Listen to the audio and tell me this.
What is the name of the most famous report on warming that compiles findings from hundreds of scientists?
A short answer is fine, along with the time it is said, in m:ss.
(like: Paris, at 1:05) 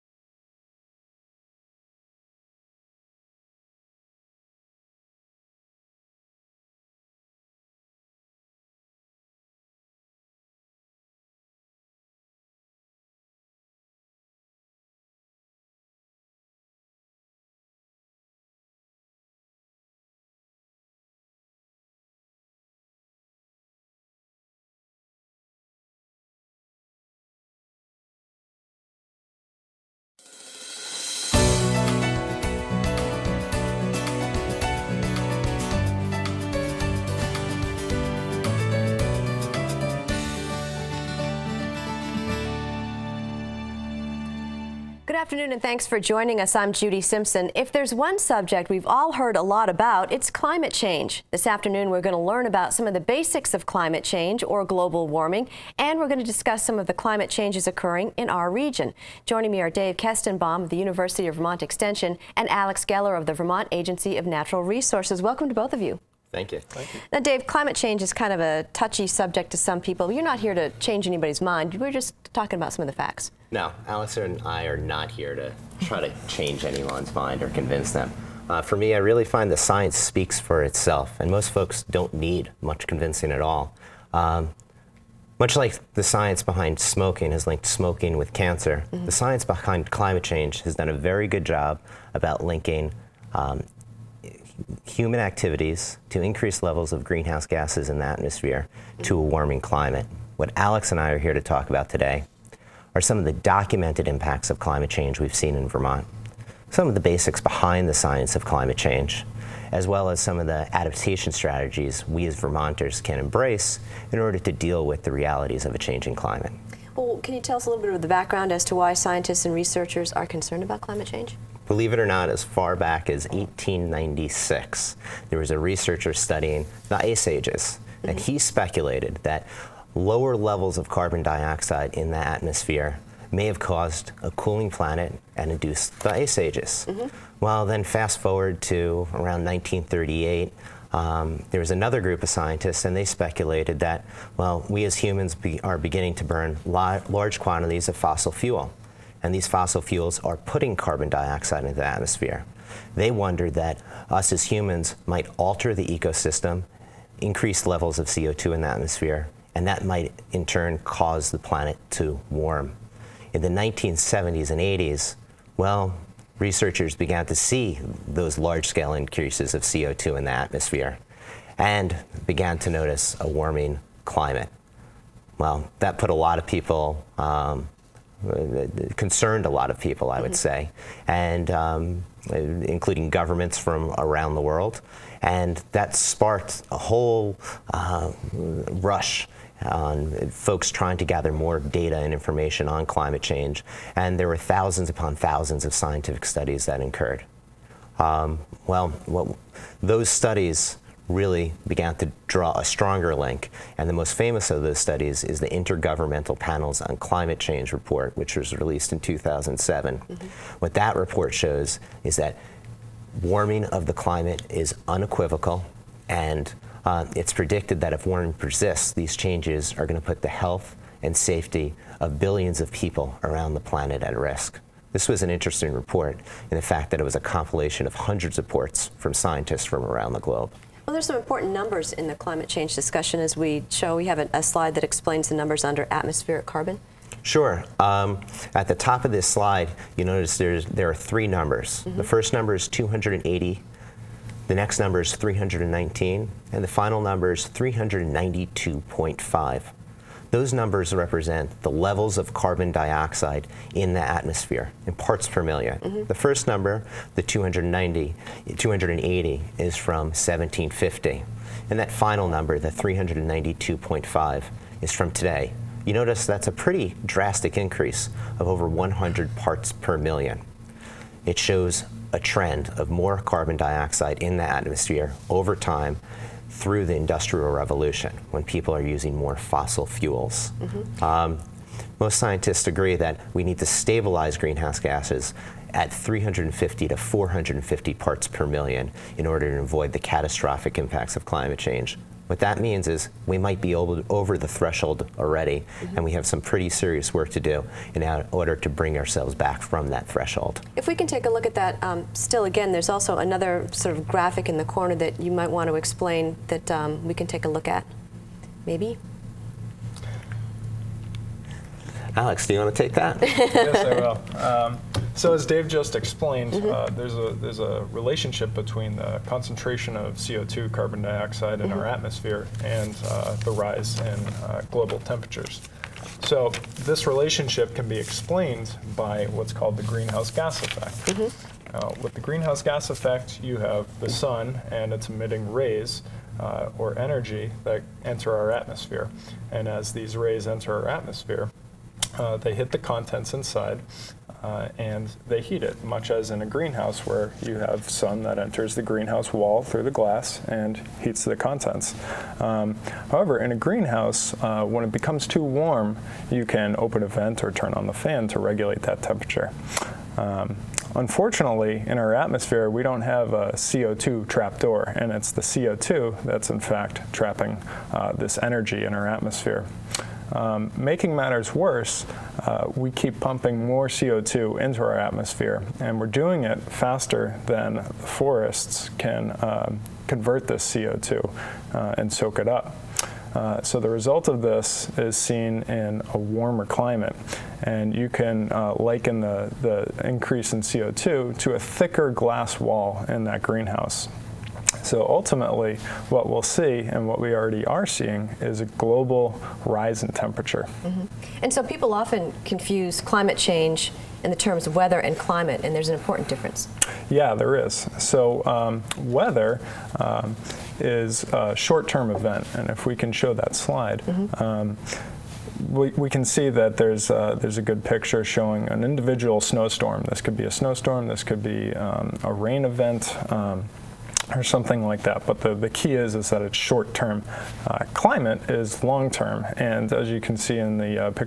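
Intergovernmental Panels on Climate Change, at 3:25.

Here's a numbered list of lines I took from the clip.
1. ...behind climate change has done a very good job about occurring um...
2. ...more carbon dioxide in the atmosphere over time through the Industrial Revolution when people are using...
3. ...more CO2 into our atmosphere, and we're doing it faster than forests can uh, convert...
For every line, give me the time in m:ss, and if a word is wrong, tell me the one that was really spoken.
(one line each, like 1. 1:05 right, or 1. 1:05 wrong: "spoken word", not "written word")
1. 1:29 wrong: "linking", not "occurring"
2. 4:32 right
3. 6:13 right.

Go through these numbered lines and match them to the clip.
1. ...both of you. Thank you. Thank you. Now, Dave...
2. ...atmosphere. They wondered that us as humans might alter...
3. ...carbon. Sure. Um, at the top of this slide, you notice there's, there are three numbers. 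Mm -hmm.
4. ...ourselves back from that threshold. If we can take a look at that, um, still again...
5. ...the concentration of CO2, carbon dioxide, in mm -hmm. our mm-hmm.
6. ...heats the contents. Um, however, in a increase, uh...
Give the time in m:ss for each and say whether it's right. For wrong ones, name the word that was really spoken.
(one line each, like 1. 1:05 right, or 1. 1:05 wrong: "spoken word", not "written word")
1. 1:05 right
2. 2:31 right
3. 3:56 right
4. 4:58 right
5. 5:18 right
6. 5:51 wrong: "greenhouse", not "increase".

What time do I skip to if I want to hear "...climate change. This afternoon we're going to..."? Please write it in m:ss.
0:50.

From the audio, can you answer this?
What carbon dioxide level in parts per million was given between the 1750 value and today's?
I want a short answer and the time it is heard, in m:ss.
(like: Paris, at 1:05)
319, at 4:05.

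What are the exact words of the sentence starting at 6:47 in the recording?
So um, weather um, is a short-term event, and if we can show that slide.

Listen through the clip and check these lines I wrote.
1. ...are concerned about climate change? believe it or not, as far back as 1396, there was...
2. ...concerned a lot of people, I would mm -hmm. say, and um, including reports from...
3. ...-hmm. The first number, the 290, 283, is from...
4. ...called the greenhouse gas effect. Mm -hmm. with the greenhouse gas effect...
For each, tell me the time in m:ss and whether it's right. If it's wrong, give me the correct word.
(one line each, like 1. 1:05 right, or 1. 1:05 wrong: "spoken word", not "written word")
1. 2:00 wrong: "1896", not "1396"
2. 2:58 wrong: "governments", not "reports"
3. 4:15 wrong: "280", not "283"
4. 5:29 right.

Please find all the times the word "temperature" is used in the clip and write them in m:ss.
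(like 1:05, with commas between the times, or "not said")
5:25, 5:59, 6:40.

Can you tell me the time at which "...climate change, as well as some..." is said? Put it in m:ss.
1:48.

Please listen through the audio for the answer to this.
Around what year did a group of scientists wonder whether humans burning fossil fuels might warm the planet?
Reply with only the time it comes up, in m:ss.
2:19.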